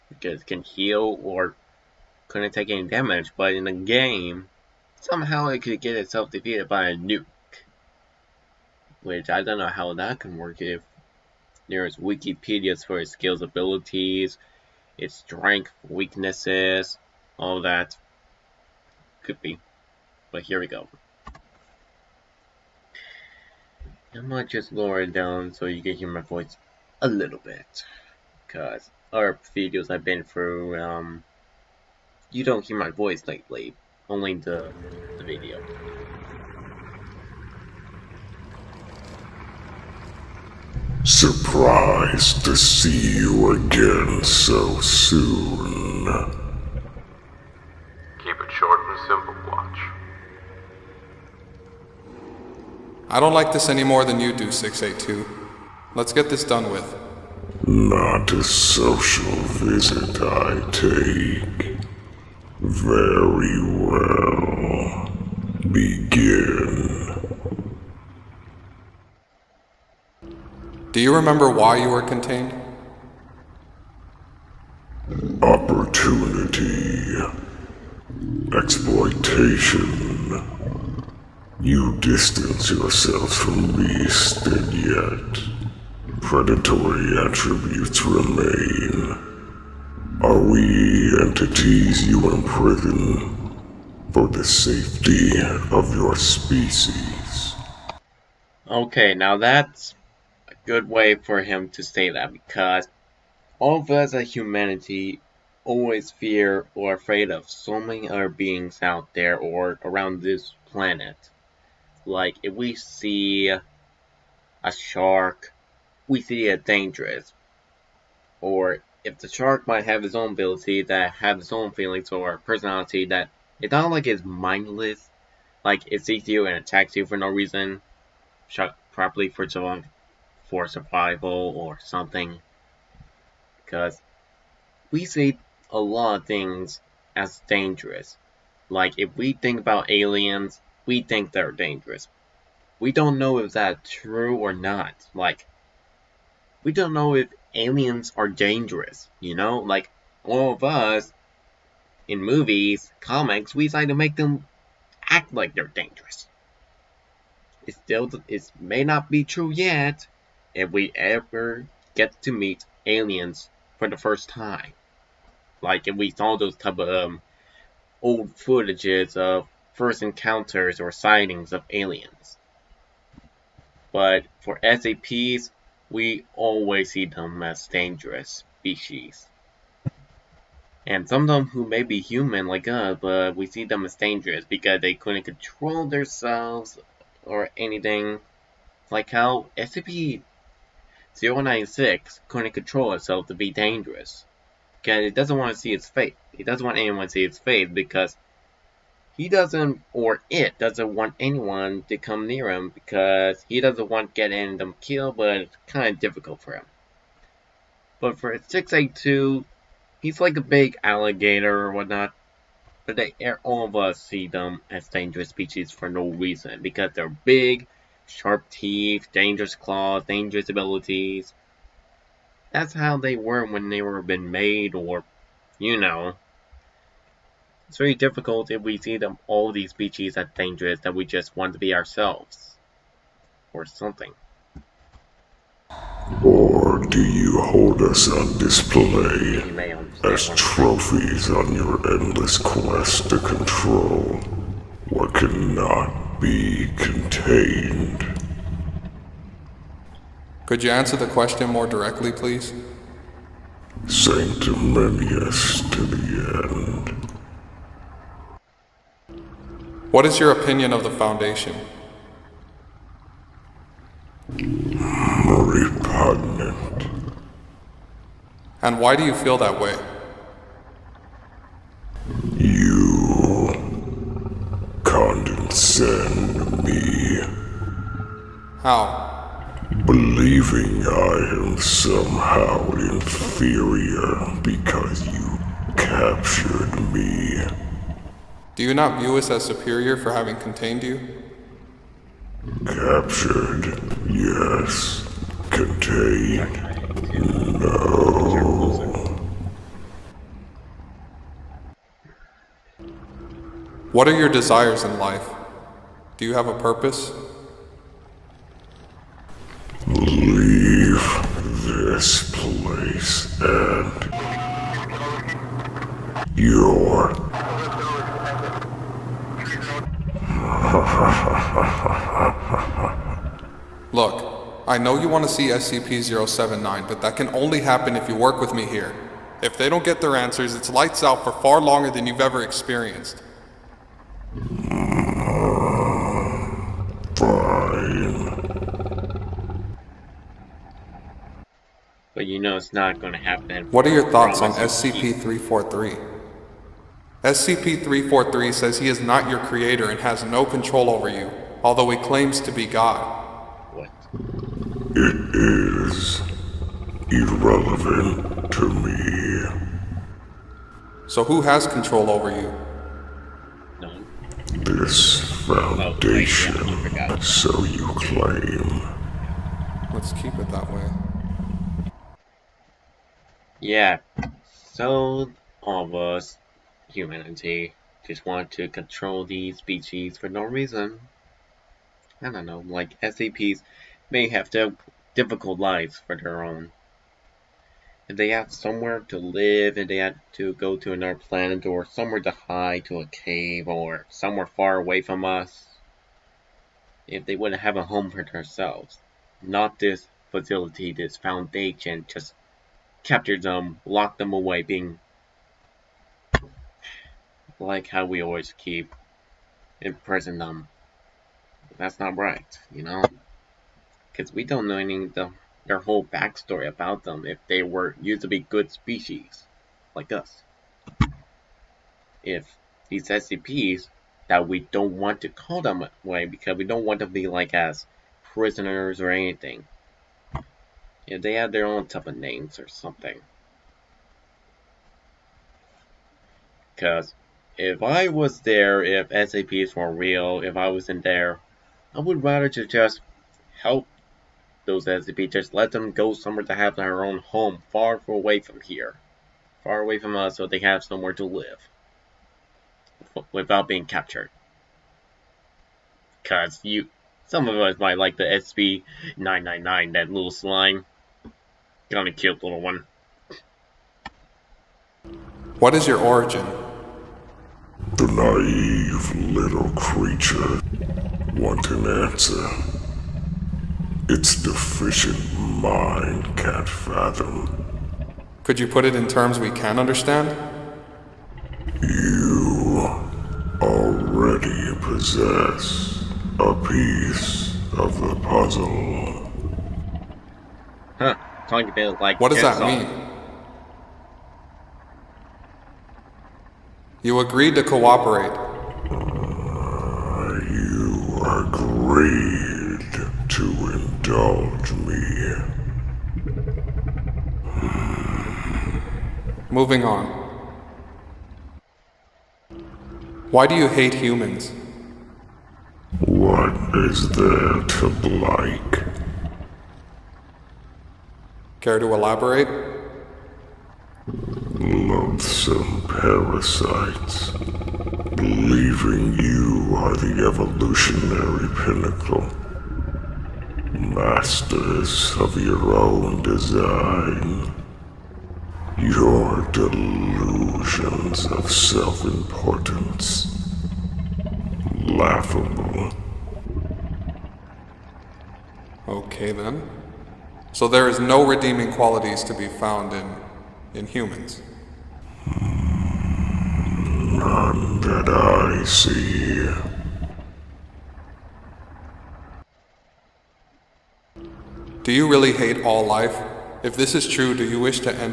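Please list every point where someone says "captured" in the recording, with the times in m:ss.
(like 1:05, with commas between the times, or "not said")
4:45, 4:52, 6:43, 7:33.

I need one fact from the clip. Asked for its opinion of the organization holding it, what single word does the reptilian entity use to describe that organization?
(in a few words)
Repugnant.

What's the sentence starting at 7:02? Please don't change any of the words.
If these SCPs that we don't want to call them way because we don't want to be like as prisoners or anything.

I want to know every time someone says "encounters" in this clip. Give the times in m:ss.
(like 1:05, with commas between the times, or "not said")
2:50.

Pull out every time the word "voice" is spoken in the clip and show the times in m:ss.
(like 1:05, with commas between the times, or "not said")
0:26, 0:32.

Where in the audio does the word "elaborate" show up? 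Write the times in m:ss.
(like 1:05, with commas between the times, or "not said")
8:41.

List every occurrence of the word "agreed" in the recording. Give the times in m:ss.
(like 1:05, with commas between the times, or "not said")
8:17, 8:21.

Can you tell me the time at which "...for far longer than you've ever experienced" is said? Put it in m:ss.
5:31.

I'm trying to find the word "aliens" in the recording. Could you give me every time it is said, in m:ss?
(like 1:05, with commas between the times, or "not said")
2:19, 2:27, 2:42, 2:51.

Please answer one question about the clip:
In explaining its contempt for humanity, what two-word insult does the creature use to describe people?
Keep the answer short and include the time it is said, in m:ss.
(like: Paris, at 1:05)
Loathsome parasites, at 8:44.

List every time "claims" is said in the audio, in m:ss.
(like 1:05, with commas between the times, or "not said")
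5:51, 6:07.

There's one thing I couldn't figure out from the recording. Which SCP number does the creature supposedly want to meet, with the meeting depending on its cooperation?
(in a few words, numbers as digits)
SCP-079.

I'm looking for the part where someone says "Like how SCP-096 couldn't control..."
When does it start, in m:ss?
3:08.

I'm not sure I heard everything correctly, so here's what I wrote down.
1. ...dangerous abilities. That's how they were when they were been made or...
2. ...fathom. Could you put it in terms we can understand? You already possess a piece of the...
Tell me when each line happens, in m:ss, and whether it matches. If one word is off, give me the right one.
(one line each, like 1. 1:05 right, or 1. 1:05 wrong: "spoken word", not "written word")
1. 3:40 right
2. 7:56 right.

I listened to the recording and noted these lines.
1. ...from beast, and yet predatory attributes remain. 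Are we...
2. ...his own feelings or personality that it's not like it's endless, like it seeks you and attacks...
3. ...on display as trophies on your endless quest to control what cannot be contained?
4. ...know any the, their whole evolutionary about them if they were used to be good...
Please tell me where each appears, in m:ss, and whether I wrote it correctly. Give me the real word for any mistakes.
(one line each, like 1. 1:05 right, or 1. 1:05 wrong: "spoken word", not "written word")
1. 1:23 right
2. 2:01 wrong: "mindless", not "endless"
3. 3:58 right
4. 6:54 wrong: "backstory", not "evolutionary".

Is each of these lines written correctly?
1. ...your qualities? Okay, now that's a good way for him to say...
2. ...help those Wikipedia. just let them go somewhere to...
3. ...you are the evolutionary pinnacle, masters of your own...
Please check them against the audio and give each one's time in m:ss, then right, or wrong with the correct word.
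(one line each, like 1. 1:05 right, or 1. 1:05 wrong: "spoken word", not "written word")
1. 1:35 wrong: "species", not "qualities"
2. 7:23 wrong: "SAPs", not "Wikipedia"
3. 8:49 right.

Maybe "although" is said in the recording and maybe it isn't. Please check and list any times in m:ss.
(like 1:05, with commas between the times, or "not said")
5:51.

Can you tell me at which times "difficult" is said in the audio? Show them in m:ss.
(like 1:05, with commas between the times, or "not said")
3:25, 3:47, 6:25.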